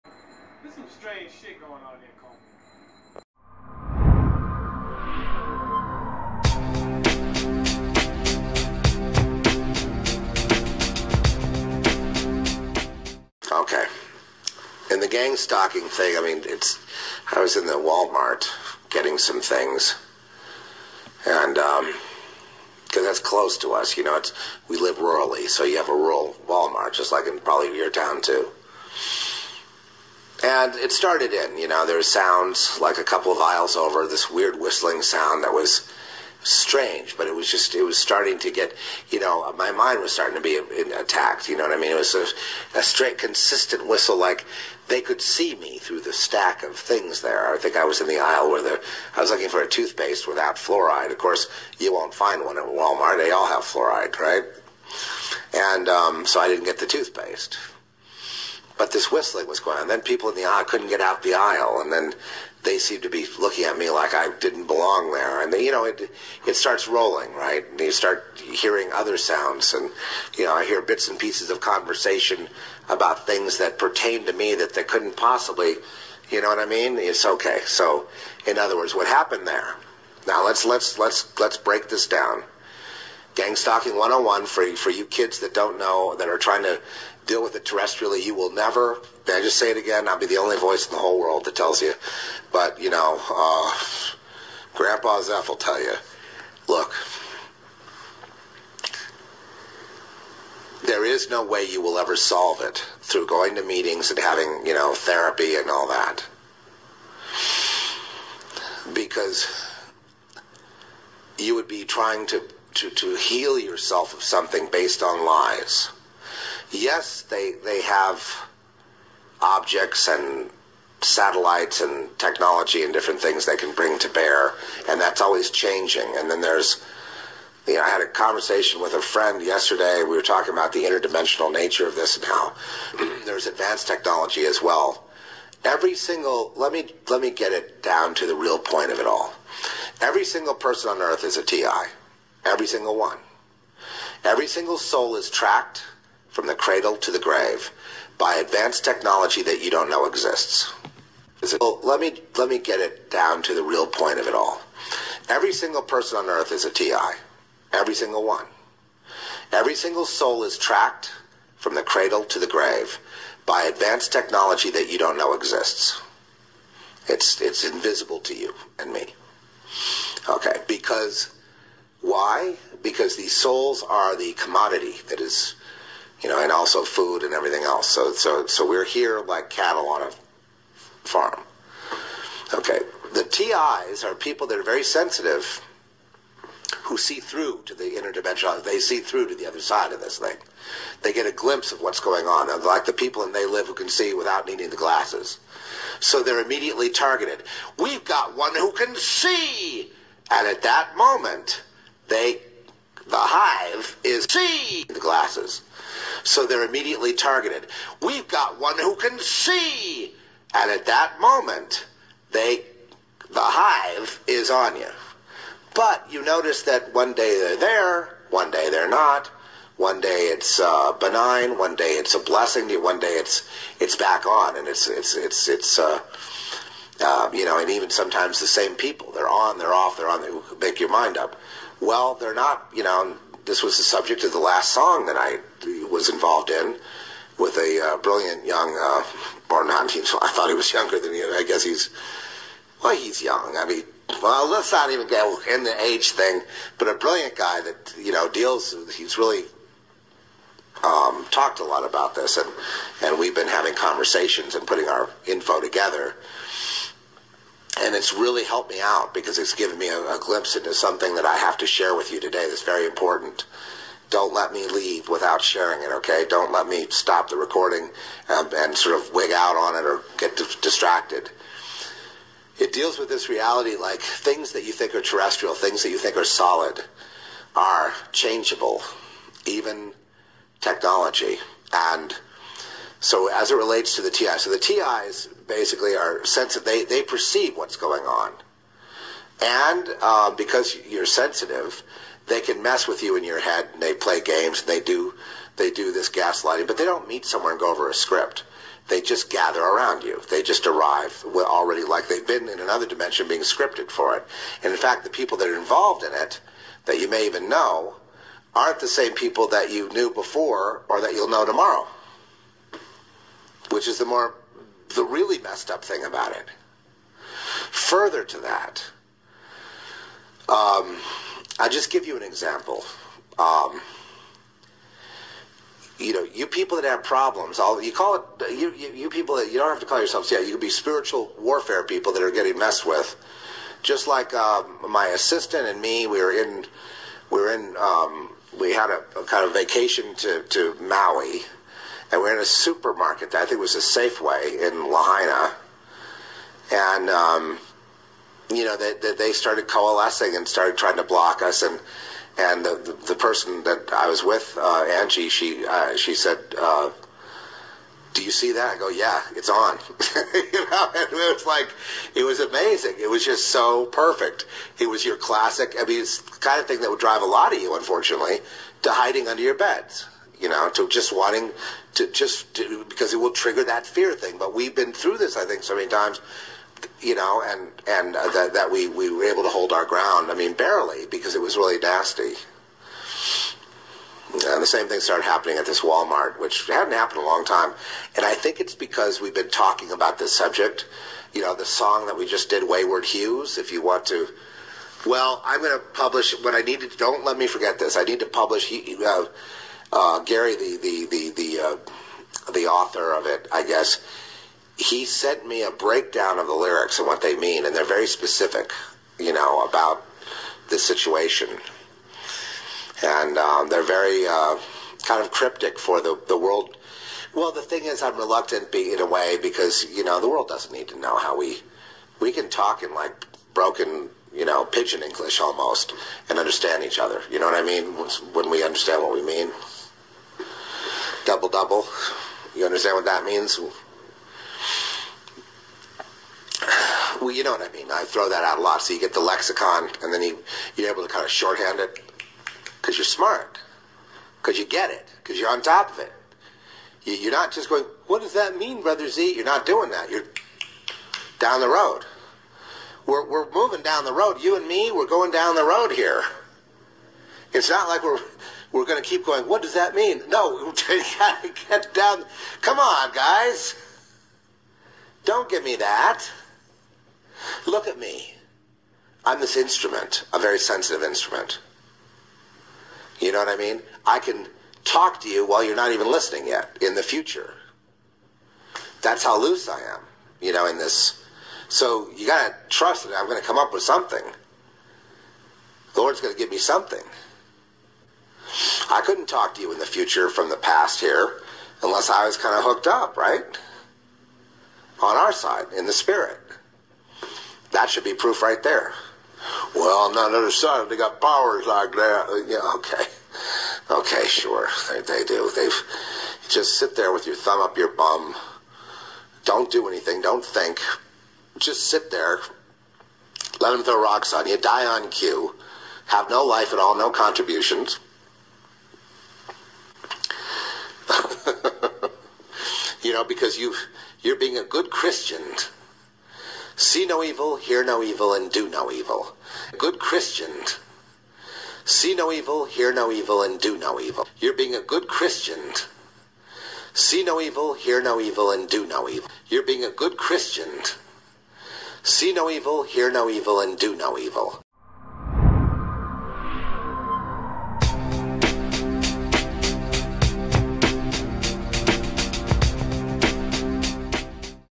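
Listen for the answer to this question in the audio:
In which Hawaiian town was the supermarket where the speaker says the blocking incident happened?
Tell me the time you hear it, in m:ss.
5:44.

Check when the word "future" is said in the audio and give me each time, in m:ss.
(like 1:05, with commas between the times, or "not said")
7:57, 8:09.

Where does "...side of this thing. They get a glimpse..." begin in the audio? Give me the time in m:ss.
3:09.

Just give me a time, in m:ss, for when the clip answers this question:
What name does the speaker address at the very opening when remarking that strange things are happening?
0:02.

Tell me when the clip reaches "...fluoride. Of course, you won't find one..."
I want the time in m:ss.
0:50.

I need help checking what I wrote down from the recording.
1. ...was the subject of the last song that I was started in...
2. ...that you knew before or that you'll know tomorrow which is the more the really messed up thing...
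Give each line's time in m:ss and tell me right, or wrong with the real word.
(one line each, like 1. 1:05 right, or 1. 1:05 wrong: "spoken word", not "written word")
1. 3:53 wrong: "involved", not "started"
2. 5:09 right.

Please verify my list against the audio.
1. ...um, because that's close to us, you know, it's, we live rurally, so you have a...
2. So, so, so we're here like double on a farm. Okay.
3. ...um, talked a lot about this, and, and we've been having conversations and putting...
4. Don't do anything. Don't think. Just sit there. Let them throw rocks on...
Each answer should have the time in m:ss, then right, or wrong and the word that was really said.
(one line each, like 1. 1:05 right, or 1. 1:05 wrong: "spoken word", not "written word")
1. 0:21 right
2. 2:57 wrong: "cattle", not "double"
3. 4:10 right
4. 8:29 right.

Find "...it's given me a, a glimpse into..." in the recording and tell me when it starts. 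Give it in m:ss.
4:19.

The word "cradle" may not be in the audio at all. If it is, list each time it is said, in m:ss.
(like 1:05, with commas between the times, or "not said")
2:26, 2:41.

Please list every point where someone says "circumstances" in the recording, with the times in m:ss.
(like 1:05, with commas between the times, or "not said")
not said.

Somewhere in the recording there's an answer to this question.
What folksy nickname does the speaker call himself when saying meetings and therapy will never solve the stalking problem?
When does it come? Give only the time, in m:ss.
1:34.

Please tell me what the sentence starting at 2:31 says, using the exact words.
Well, let me let me get it down to the real point of it all.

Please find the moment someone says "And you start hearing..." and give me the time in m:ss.
1:07.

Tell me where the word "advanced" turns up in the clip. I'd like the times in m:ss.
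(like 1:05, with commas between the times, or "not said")
2:13, 2:28, 2:43.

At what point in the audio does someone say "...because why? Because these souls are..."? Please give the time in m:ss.
2:50.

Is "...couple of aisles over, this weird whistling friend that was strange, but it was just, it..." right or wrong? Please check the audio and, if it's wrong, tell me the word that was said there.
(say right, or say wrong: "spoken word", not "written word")
wrong: "sound", not "friend".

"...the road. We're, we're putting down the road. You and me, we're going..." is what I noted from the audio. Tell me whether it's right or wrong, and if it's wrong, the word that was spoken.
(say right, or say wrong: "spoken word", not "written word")
wrong: "moving", not "putting".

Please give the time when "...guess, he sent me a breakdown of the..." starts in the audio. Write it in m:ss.
6:43.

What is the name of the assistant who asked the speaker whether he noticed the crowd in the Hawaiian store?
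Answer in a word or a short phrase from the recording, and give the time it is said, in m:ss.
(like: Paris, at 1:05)
Angie, at 5:54.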